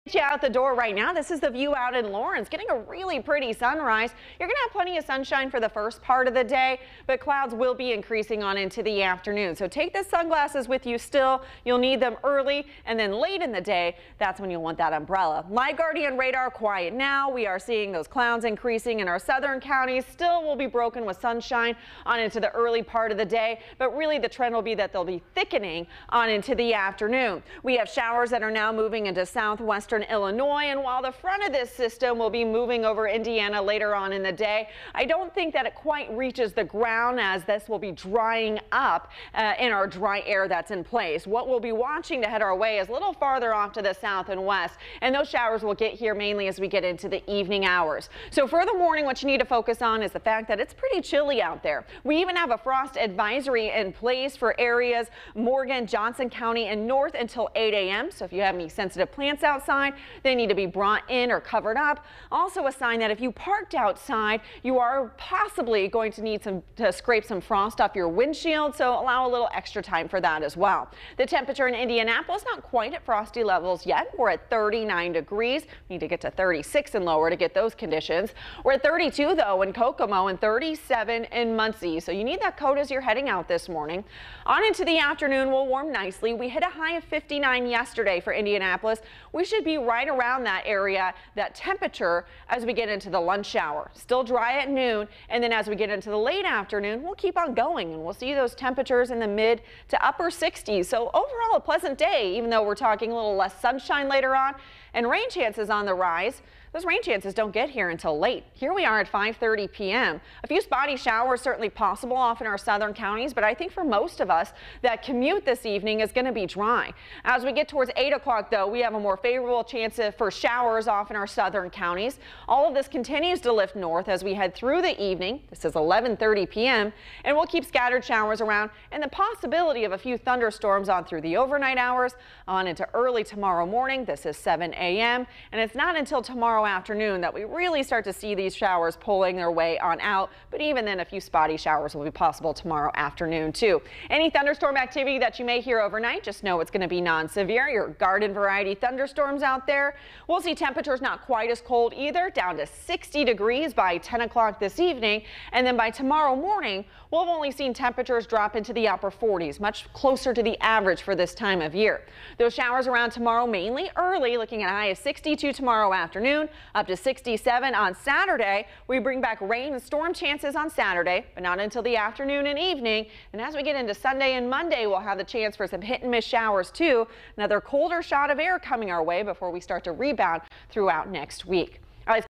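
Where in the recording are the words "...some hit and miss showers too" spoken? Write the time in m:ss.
2:55.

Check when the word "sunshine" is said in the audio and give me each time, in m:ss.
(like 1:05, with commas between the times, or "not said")
0:05, 0:21, 1:43.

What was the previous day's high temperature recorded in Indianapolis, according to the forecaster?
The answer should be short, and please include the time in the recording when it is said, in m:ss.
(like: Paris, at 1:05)
59, at 1:27.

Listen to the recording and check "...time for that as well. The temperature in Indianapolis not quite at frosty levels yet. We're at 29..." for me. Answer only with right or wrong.
wrong.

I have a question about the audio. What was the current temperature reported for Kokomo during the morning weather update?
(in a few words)
32.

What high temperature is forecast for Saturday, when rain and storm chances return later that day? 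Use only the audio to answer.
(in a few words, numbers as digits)
67.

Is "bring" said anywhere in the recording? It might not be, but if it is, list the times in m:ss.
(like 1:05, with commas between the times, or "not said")
2:48.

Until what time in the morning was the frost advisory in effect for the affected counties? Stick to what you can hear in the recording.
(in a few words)
8 a.m.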